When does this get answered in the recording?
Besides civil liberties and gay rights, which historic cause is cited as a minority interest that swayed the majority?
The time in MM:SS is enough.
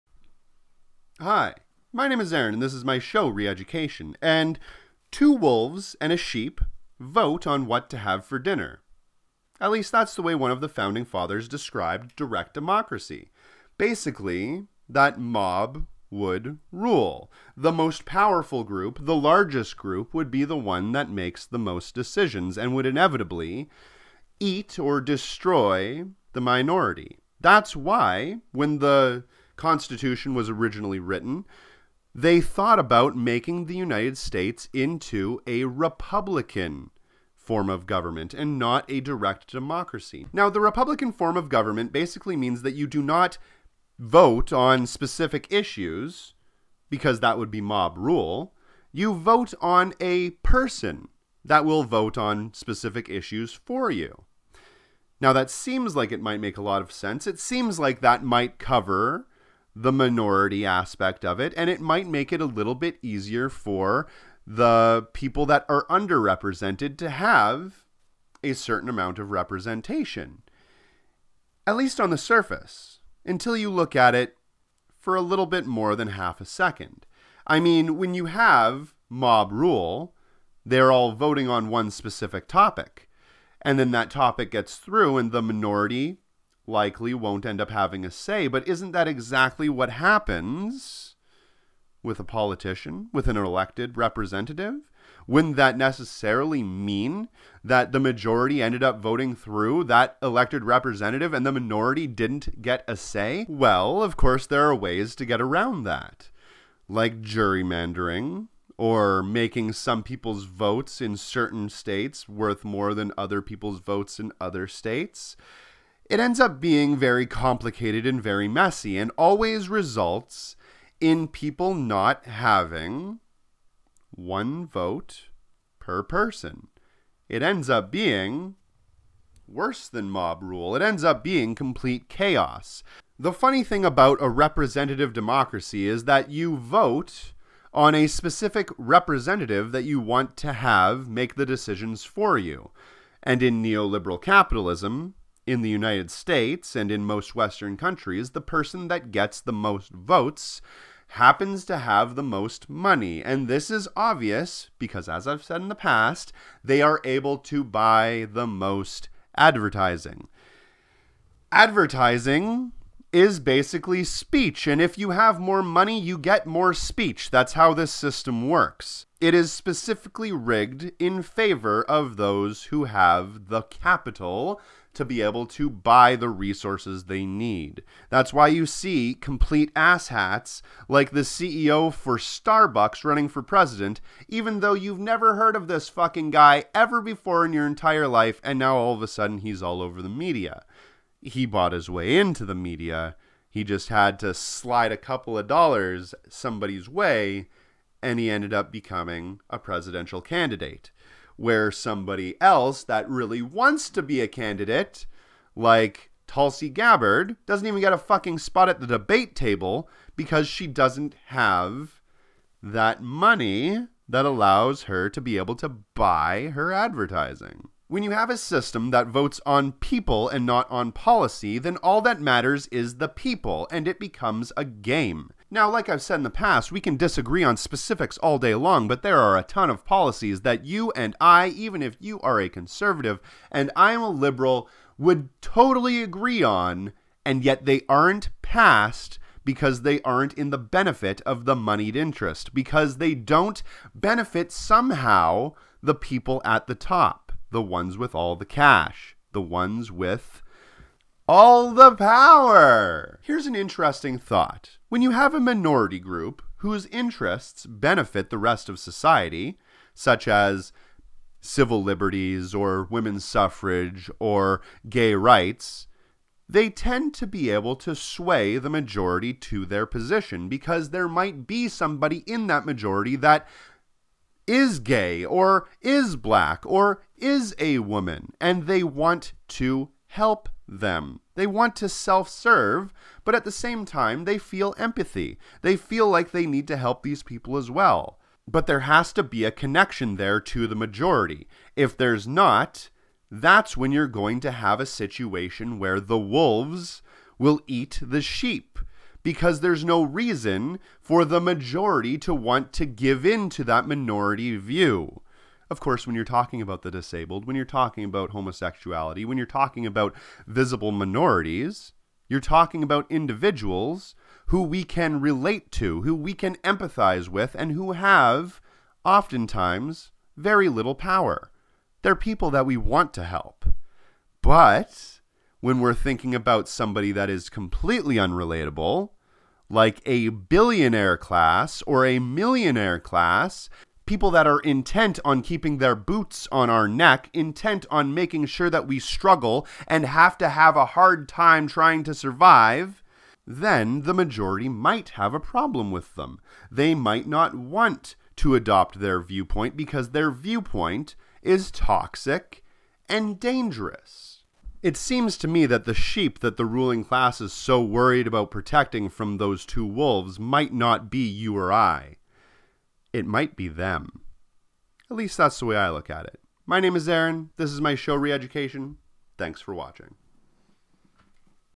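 04:22.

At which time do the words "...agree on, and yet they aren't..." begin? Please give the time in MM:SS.
03:56.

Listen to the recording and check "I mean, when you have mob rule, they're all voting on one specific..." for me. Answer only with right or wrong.
right.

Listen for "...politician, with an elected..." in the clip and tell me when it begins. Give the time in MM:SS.
01:32.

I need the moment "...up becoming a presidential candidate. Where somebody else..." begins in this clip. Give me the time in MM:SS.
03:18.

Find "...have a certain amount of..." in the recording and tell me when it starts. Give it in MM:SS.
01:07.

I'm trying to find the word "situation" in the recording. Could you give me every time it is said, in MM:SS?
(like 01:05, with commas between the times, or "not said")
04:54.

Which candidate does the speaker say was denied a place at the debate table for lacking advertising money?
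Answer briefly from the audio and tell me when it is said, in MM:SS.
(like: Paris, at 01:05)
Tulsi Gabbard, at 03:26.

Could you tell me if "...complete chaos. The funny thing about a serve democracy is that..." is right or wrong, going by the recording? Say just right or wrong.
wrong.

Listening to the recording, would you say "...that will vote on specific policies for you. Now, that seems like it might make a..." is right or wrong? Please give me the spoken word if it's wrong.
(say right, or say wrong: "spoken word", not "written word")
wrong: "issues", not "policies".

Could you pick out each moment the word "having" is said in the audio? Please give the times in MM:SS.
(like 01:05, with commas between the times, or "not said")
01:27, 02:02.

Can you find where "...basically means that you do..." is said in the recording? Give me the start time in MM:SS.
00:41.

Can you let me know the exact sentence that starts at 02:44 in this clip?
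And if you have more money, you get more speech.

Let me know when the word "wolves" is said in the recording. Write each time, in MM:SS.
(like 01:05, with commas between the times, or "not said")
00:05, 04:56, 05:59.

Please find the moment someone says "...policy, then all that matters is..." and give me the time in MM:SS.
03:40.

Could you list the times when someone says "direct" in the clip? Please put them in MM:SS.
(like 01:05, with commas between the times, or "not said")
00:12, 00:39.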